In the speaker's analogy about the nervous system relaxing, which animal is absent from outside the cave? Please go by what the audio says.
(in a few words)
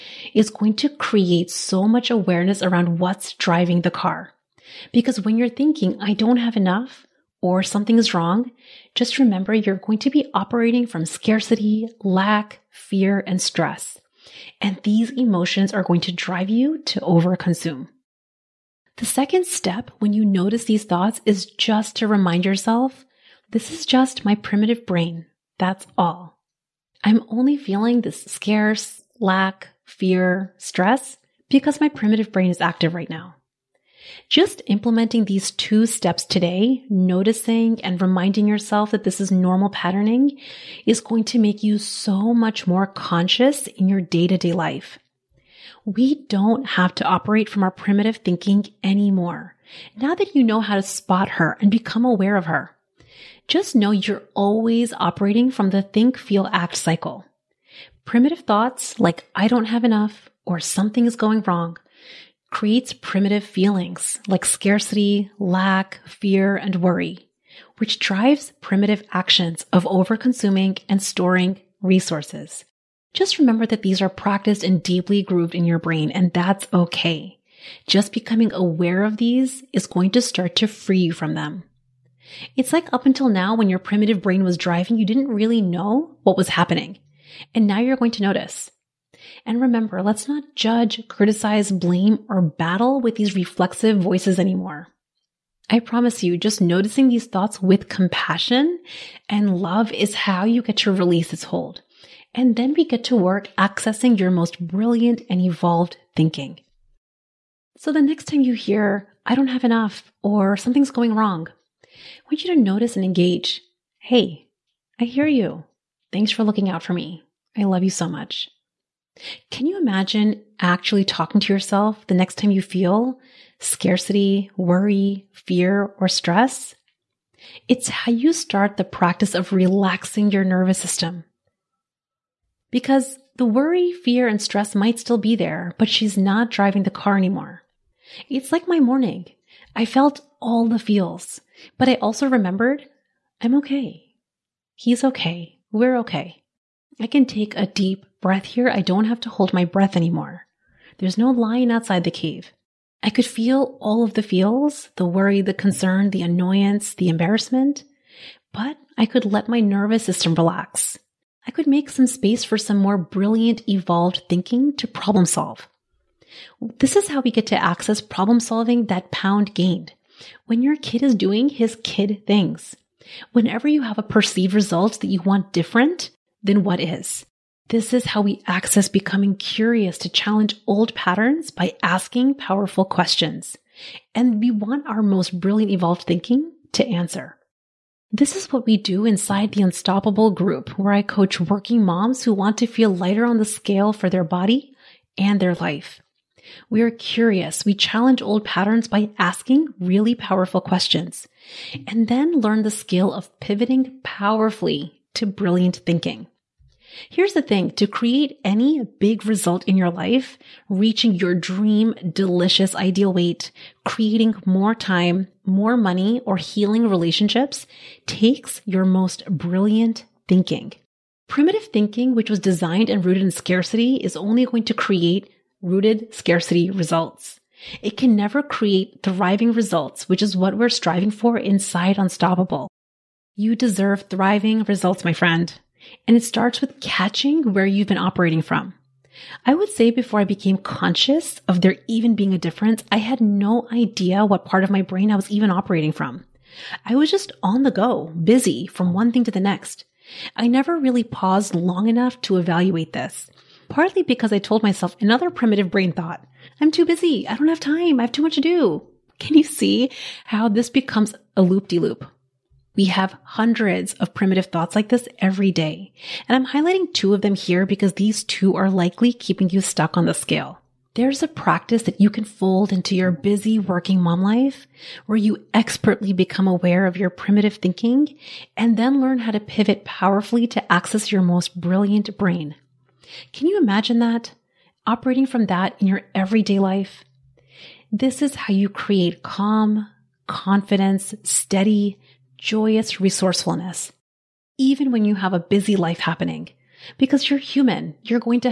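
Lion.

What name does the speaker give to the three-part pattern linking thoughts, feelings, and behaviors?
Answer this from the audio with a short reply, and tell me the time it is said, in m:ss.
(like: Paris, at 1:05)
Think, feel, act cycle, at 0:55.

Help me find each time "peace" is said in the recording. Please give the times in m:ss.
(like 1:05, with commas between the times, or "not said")
not said.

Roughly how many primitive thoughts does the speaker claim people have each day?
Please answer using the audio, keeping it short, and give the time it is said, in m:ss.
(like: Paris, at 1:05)
Hundreds, at 4:23.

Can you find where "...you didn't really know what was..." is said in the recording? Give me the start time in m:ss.
1:24.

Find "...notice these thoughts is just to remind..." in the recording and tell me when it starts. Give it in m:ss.
0:20.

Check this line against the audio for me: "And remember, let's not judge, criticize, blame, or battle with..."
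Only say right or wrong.
right.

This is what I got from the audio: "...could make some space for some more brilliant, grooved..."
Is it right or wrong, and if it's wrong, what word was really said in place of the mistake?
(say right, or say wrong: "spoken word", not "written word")
wrong: "evolved", not "grooved".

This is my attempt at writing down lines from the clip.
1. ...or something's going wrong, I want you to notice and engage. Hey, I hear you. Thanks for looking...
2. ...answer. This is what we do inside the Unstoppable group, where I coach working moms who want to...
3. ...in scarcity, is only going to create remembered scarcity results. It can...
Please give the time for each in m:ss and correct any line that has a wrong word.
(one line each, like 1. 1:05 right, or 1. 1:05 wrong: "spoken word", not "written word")
1. 1:50 right
2. 3:06 right
3. 3:43 wrong: "rooted", not "remembered".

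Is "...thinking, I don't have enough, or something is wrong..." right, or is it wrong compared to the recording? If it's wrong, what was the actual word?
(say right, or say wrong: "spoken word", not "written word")
right.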